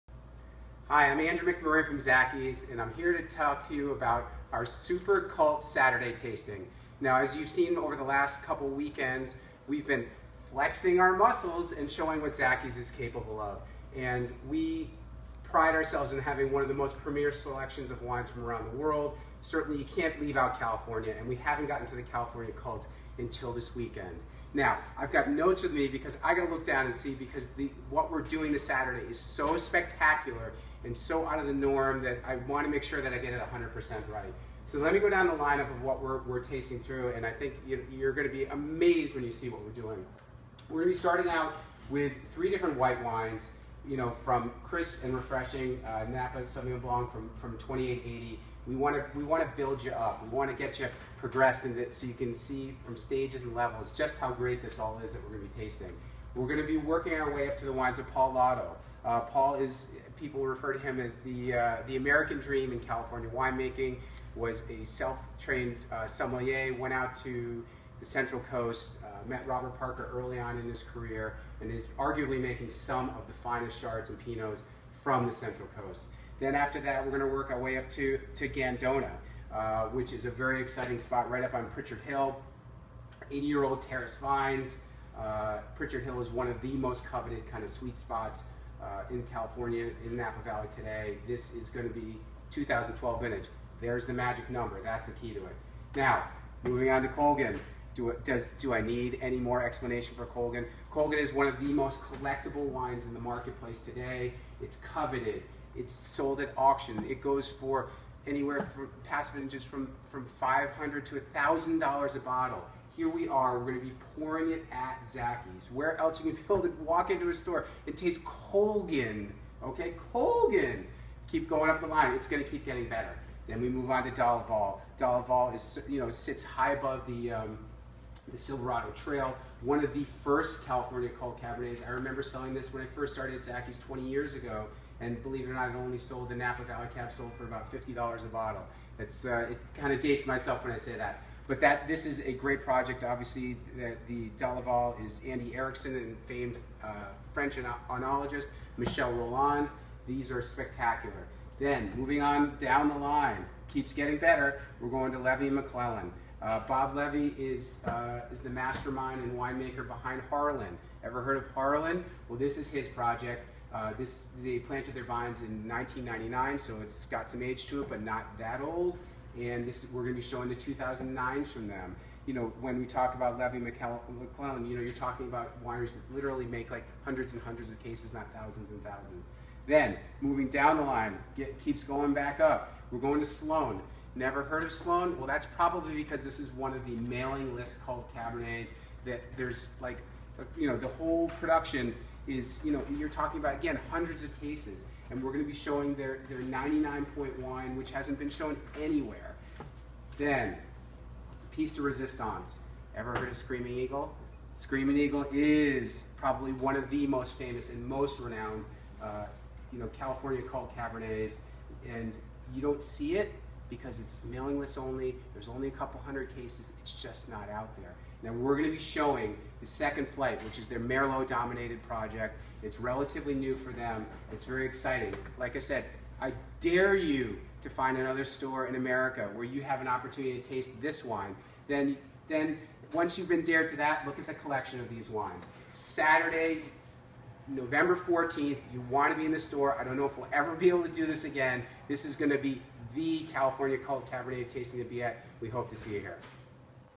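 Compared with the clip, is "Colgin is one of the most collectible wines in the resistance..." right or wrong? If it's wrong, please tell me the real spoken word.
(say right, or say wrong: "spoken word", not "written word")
wrong: "marketplace", not "resistance".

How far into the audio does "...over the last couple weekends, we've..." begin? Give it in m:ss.
0:07.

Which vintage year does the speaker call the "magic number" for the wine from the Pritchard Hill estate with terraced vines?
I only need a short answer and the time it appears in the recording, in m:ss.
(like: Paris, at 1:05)
2012, at 1:32.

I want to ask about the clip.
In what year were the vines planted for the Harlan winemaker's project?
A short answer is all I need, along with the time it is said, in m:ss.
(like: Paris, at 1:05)
1999, at 2:45.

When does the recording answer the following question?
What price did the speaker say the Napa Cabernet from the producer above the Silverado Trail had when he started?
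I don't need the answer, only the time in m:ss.
2:17.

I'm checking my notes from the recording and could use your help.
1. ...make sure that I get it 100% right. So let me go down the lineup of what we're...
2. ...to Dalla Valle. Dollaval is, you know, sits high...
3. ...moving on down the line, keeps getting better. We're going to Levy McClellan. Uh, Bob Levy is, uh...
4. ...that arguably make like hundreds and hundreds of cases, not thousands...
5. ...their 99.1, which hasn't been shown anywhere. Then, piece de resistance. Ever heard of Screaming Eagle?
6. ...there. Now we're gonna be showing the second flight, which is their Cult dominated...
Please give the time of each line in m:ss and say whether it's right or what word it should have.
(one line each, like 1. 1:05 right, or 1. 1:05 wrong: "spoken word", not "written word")
1. 0:32 right
2. 2:04 right
3. 2:31 right
4. 2:55 wrong: "literally", not "arguably"
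5. 3:16 right
6. 3:37 wrong: "Merlot", not "Cult".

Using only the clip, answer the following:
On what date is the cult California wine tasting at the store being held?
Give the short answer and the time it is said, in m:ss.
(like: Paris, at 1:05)
Saturday, November 14th, at 3:55.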